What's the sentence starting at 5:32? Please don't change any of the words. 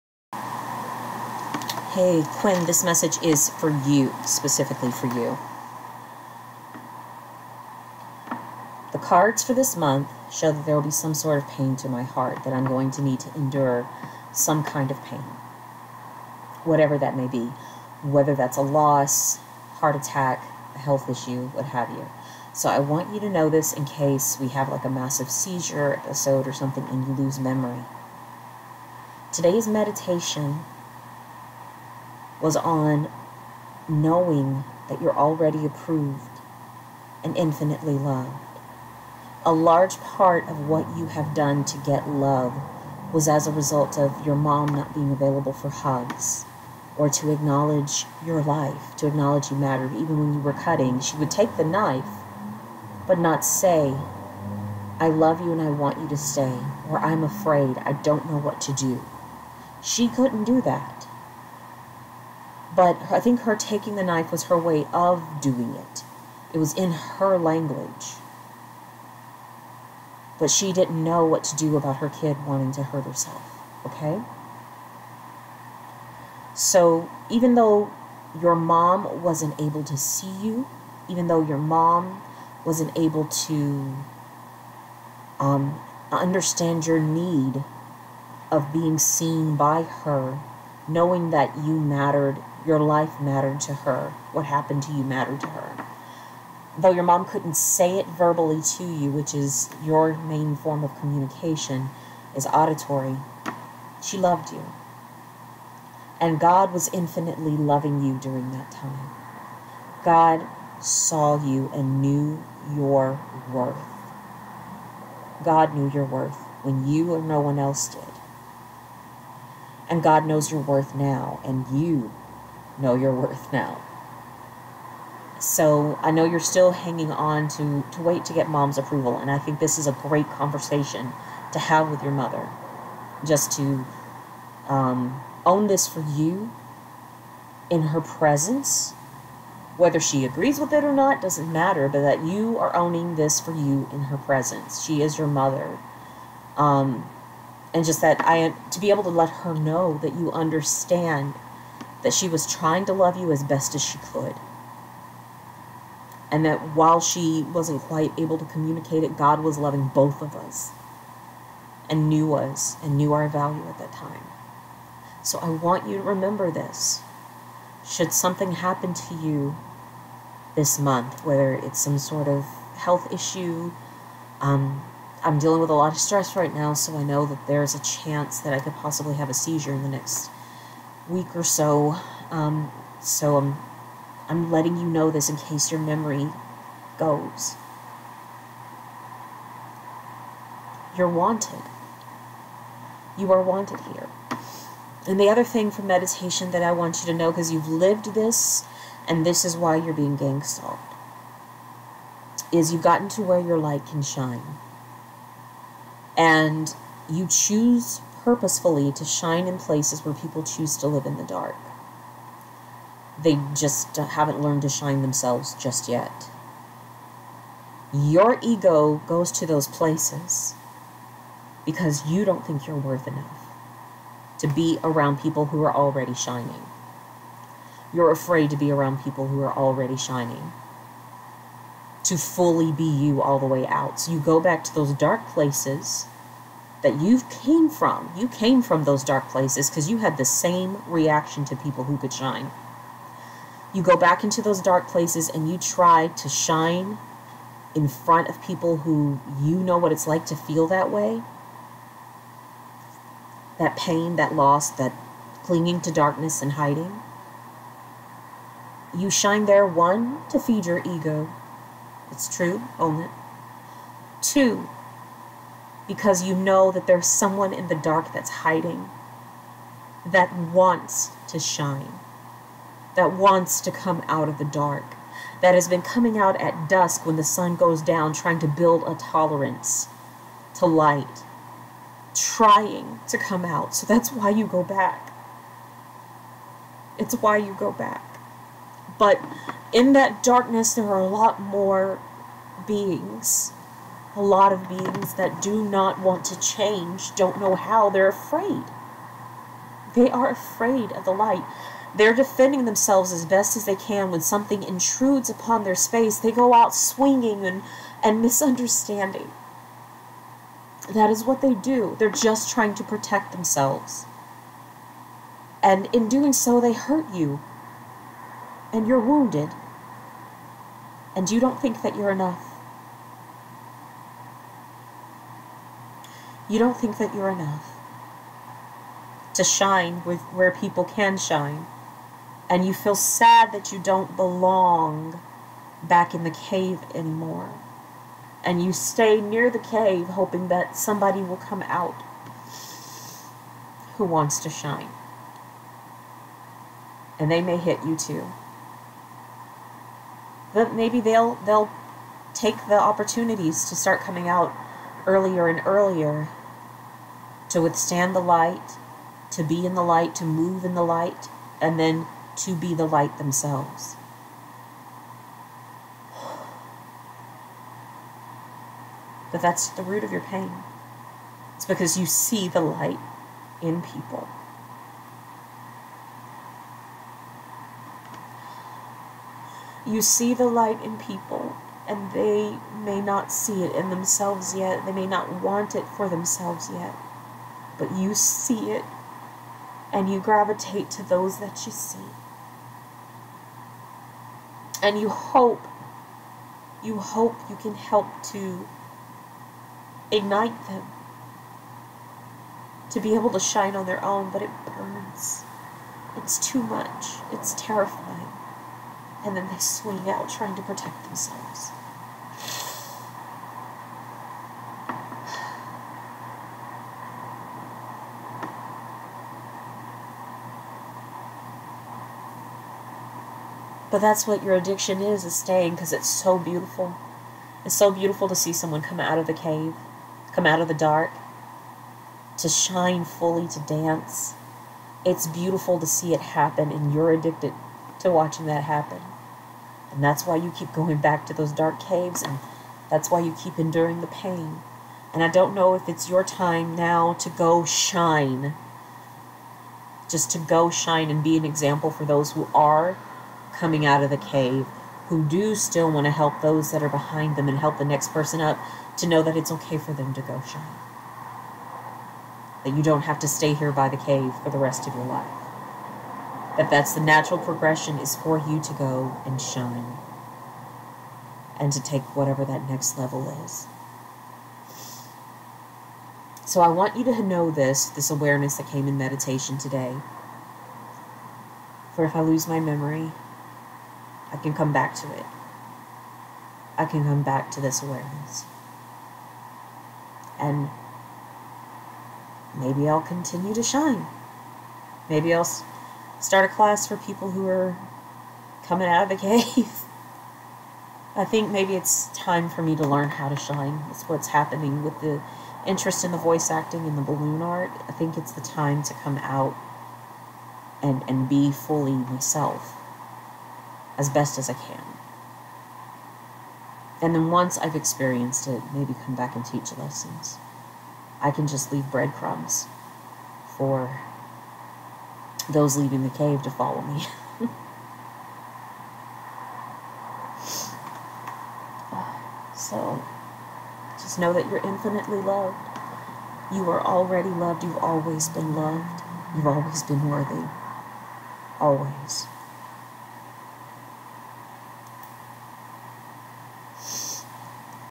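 And you feel sad that you don't belong back in the cave anymore.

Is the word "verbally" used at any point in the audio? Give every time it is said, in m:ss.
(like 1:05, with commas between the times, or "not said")
1:38.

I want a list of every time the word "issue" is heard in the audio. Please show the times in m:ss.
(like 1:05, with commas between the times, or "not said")
0:21, 2:53.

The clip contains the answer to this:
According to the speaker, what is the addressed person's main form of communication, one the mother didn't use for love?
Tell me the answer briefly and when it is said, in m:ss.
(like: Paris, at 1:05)
auditory, at 1:42.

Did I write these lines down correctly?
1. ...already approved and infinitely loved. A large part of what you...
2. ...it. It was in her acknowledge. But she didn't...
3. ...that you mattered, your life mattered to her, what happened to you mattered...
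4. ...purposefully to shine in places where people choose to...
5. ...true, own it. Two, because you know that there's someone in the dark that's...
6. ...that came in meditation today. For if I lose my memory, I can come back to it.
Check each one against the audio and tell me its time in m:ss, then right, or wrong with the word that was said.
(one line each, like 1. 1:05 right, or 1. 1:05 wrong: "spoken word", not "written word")
1. 0:35 right
2. 1:05 wrong: "language", not "acknowledge"
3. 1:31 right
4. 3:28 right
5. 4:22 right
6. 7:58 right.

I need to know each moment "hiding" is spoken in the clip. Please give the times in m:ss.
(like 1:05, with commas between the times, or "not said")
4:16, 4:28.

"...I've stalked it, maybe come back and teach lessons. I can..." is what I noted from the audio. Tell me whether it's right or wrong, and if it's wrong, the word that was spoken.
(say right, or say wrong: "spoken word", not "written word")
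wrong: "experienced", not "stalked".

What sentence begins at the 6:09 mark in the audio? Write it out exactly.
But that's the root of your pain.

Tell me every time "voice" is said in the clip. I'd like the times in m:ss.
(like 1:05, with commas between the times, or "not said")
8:26.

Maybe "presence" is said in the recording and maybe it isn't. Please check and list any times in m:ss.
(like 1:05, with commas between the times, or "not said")
2:17, 2:24.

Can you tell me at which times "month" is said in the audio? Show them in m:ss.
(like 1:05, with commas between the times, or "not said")
0:09, 2:50.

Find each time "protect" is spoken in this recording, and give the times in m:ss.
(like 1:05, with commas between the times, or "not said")
5:12, 6:50.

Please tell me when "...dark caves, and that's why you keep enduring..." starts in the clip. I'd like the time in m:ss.
7:21.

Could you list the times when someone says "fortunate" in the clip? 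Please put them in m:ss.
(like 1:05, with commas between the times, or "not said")
not said.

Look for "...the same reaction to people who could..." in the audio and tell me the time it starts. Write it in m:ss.
4:00.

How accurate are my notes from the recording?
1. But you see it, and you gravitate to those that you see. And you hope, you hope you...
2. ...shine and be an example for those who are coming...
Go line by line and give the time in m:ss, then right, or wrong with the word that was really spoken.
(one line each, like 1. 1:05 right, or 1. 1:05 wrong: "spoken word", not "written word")
1. 6:27 right
2. 7:30 right.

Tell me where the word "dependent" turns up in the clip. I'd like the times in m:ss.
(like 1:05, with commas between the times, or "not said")
not said.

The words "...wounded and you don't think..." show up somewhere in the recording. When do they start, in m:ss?
5:18.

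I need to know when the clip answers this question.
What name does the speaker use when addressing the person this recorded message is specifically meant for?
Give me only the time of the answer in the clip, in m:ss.
0:02.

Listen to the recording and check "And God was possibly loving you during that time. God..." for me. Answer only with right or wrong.
wrong.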